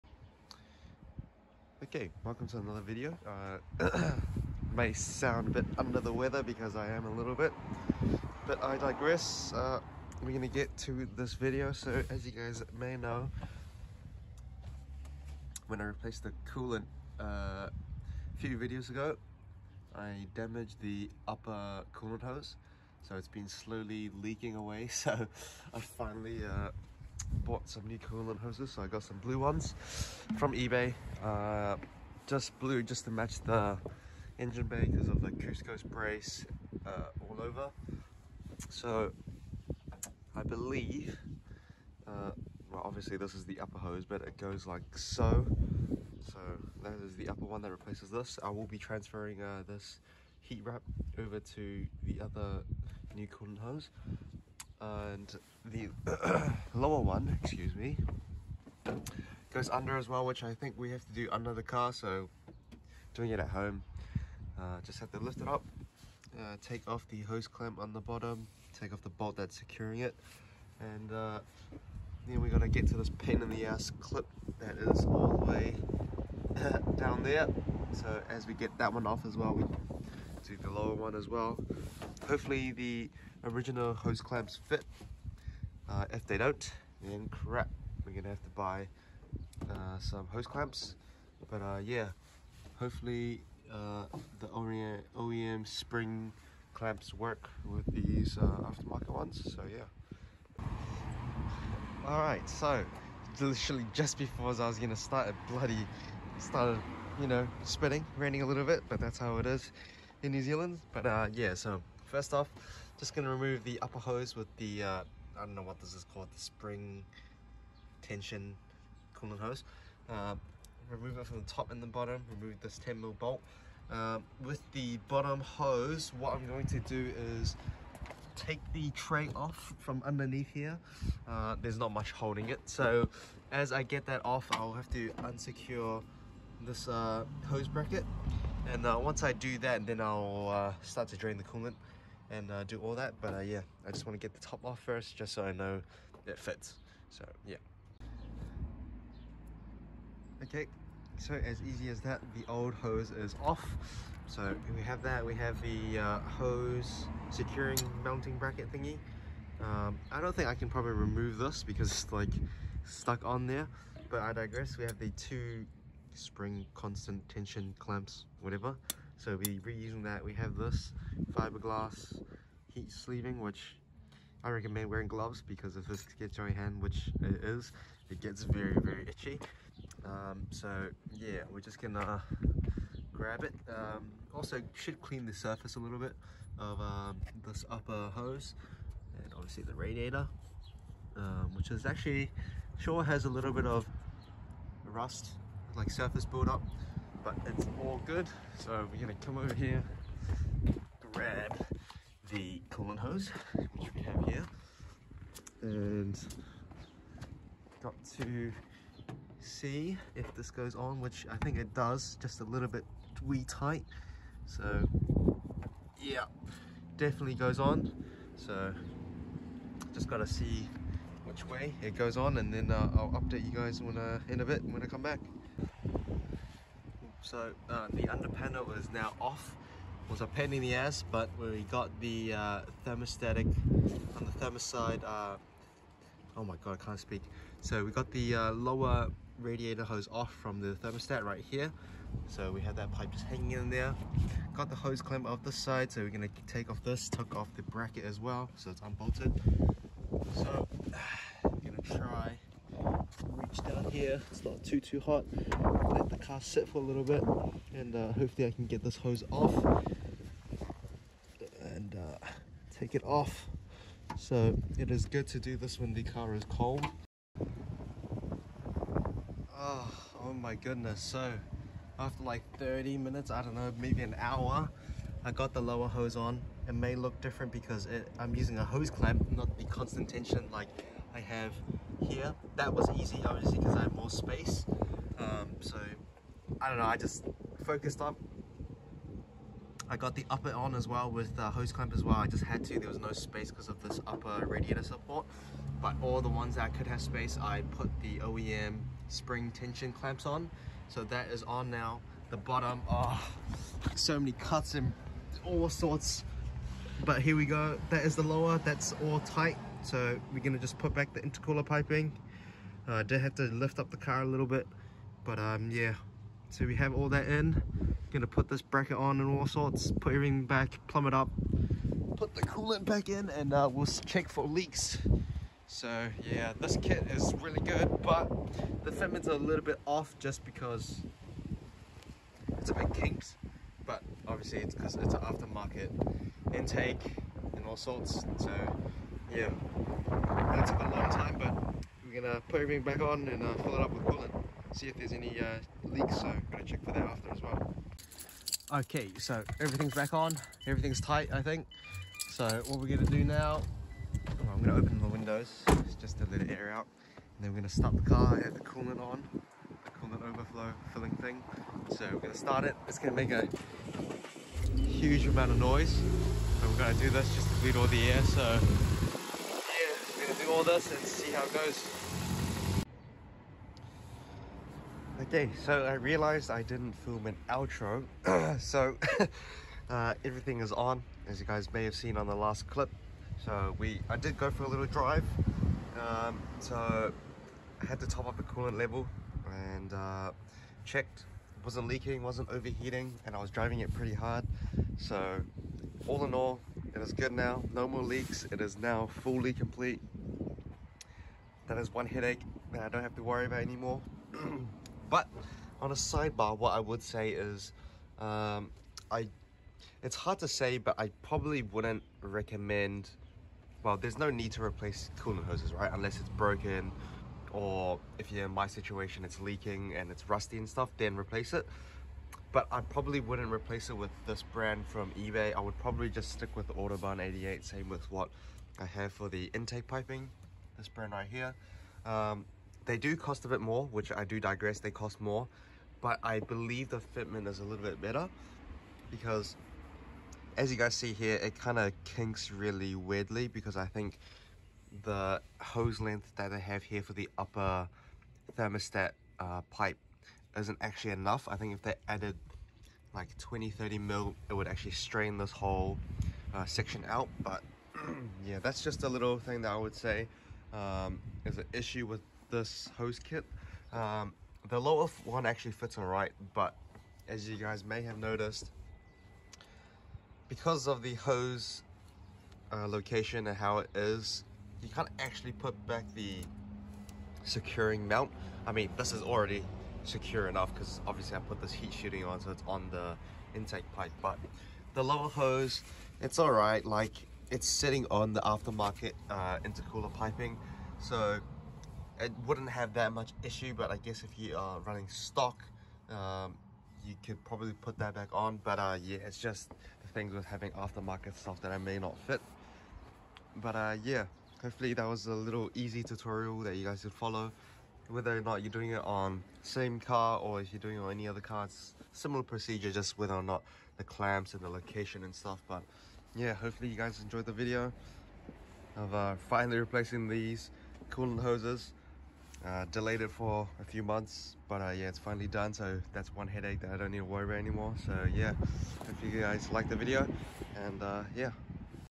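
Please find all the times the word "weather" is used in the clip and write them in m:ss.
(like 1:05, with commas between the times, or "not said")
0:06.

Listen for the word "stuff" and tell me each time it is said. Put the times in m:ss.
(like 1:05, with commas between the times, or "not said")
7:00, 8:21, 8:35.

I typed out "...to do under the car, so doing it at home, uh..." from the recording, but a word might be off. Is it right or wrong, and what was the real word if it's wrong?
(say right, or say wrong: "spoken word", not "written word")
right.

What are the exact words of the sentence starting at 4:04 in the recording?
Got the hose clamp off this side, so we're gonna take off this, took off the bracket as well, so it's unbolted.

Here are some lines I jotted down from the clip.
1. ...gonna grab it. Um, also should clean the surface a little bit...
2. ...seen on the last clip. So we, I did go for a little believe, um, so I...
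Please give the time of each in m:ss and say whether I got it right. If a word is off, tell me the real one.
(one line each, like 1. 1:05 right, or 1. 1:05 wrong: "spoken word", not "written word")
1. 3:01 right
2. 6:21 wrong: "drive", not "believe".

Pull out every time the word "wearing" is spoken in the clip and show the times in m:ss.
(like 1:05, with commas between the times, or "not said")
2:54.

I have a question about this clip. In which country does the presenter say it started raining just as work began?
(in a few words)
New Zealand.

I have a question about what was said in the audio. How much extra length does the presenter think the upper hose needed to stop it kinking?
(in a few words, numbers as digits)
20 to 30 mm.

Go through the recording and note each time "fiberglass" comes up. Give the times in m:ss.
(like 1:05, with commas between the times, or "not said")
2:51.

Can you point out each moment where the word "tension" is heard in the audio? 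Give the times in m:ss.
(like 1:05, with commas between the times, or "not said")
1:58, 2:47, 4:40, 4:59.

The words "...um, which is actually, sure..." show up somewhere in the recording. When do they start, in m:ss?
3:11.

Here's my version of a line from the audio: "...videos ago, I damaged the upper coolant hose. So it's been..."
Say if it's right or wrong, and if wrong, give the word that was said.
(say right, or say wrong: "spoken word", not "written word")
right.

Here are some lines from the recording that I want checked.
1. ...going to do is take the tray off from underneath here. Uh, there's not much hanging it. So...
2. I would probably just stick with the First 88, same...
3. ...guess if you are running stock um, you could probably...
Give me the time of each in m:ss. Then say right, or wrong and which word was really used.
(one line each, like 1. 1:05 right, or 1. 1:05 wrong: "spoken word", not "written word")
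1. 2:06 wrong: "holding", not "hanging"
2. 7:05 wrong: "Autobahn", not "First"
3. 8:13 right.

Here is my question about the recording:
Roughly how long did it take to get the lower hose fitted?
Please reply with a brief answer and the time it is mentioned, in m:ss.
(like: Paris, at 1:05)
30 minutes, at 4:32.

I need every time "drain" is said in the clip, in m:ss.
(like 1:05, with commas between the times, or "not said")
2:21.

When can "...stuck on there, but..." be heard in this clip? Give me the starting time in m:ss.
2:42.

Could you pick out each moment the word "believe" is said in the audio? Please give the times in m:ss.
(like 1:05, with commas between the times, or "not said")
0:40, 7:16.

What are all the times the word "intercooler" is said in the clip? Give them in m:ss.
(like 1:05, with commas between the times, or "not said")
5:11, 8:09.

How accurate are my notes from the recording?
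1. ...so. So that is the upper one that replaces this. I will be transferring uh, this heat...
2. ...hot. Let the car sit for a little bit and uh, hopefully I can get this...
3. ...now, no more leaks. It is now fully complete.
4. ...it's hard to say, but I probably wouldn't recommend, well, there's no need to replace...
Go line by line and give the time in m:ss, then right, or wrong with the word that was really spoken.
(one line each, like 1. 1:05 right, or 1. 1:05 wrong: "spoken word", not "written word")
1. 0:44 right
2. 4:14 right
3. 6:37 right
4. 6:50 right.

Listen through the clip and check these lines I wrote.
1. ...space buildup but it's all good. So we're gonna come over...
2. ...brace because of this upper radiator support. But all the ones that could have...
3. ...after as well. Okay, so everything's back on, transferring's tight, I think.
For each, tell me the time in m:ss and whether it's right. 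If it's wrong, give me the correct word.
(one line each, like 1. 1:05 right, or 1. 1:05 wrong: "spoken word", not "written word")
1. 3:15 wrong: "surface", not "space"
2. 4:53 wrong: "space", not "brace"
3. 5:47 wrong: "everything", not "transferring".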